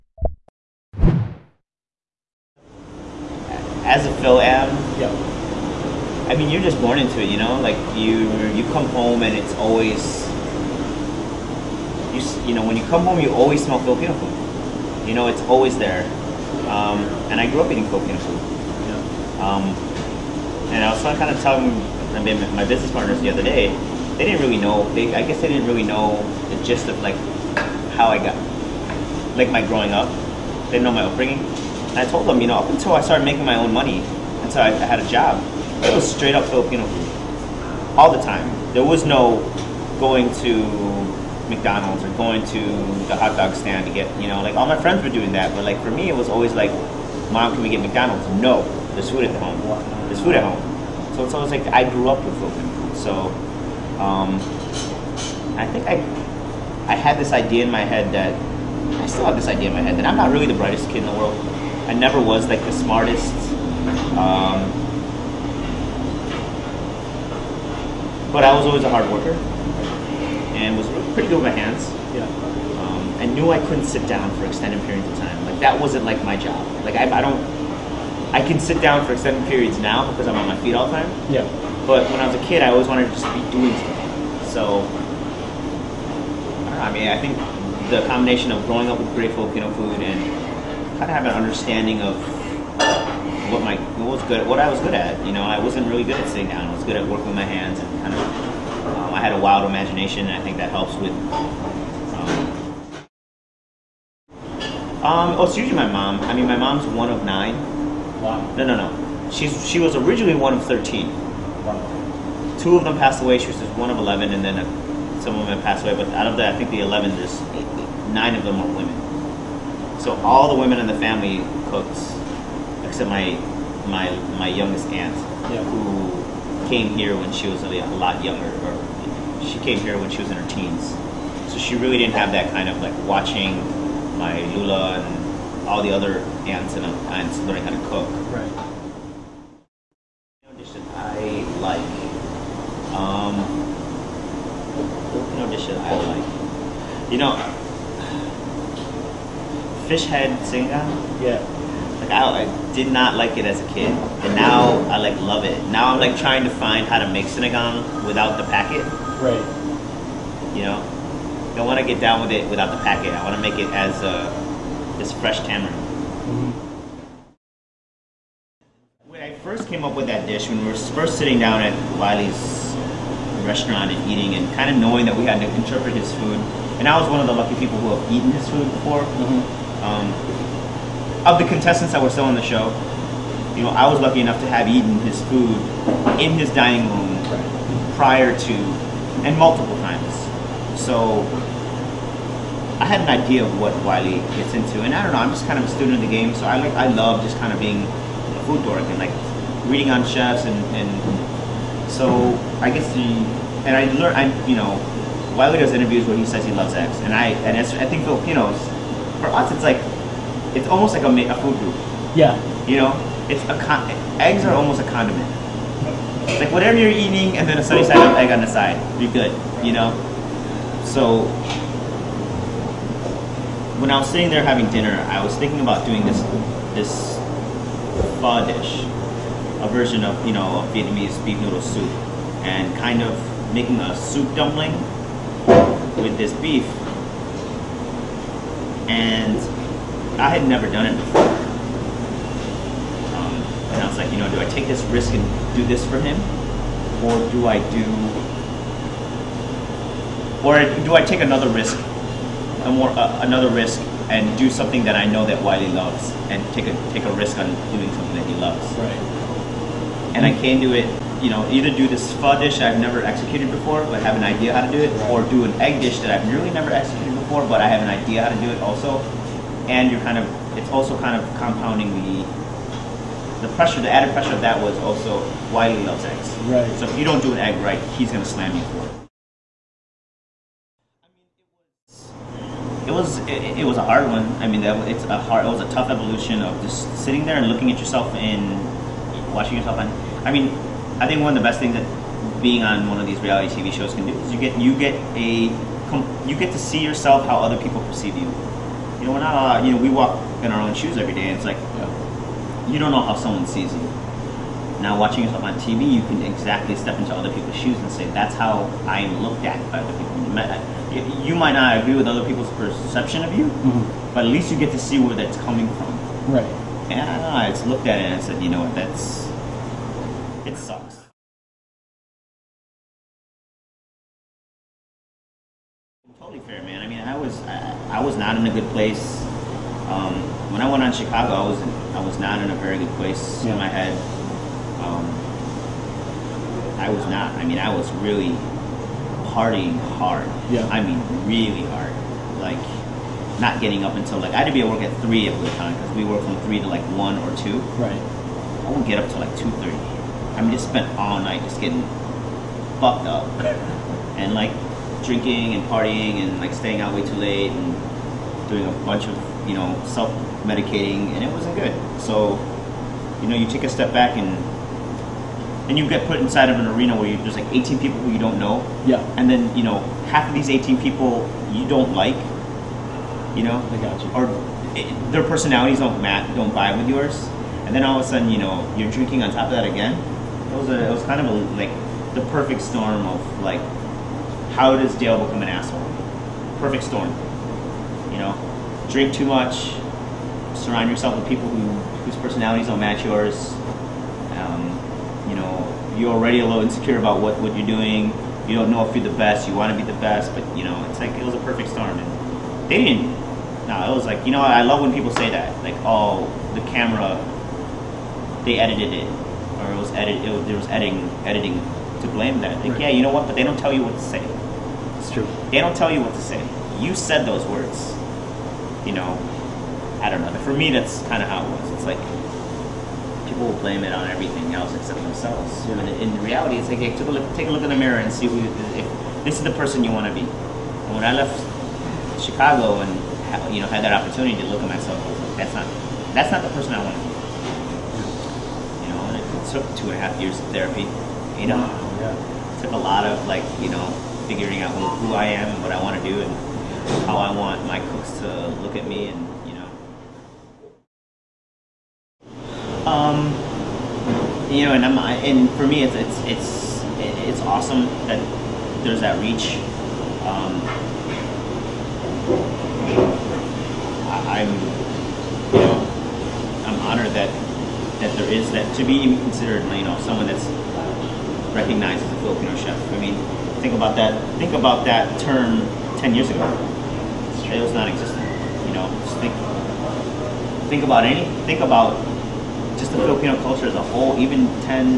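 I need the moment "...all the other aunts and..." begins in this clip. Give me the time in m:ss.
2:15.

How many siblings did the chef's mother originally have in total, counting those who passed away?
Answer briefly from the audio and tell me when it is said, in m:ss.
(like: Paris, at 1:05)
13, at 1:50.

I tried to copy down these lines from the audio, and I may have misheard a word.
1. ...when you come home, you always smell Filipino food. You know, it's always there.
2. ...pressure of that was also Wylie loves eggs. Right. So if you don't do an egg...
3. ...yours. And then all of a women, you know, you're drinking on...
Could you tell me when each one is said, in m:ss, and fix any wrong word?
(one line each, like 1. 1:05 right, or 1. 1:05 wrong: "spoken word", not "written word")
1. 0:12 right
2. 4:34 right
3. 6:16 wrong: "sudden", not "women".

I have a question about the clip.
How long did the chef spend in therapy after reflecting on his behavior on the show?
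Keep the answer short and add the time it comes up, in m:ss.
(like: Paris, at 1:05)
2.5 years, at 7:19.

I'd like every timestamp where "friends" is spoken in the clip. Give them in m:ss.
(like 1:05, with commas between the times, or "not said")
0:44.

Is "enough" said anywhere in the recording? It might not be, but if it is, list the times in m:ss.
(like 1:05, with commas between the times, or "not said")
3:04.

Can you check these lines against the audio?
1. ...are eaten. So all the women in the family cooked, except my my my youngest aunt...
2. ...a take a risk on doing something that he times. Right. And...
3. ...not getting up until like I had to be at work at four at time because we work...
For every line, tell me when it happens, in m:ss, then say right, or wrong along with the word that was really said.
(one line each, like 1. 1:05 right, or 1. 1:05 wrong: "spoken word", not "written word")
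1. 1:58 wrong: "women", not "eaten"
2. 4:16 wrong: "loves", not "times"
3. 5:43 wrong: "three", not "four".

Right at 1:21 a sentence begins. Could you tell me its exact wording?
Yeah but when I was a kid, I always wanted to just be doing something.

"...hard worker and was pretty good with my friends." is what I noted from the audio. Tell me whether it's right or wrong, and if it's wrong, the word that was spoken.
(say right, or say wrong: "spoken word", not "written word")
wrong: "hands", not "friends".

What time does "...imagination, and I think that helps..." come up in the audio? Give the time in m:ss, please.
1:39.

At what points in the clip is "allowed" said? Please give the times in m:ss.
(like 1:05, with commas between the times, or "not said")
4:59.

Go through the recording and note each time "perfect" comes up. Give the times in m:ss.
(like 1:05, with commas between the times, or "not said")
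6:22, 6:26, 6:41.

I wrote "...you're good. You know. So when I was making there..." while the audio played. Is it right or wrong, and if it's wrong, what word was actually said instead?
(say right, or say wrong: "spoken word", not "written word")
wrong: "sitting", not "making".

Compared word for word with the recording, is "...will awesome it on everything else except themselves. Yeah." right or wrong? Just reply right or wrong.
wrong.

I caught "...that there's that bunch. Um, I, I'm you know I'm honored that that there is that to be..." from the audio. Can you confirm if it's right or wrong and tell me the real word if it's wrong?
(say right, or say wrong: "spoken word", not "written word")
wrong: "reach", not "bunch".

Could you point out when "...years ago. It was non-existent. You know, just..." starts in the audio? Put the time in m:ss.
7:56.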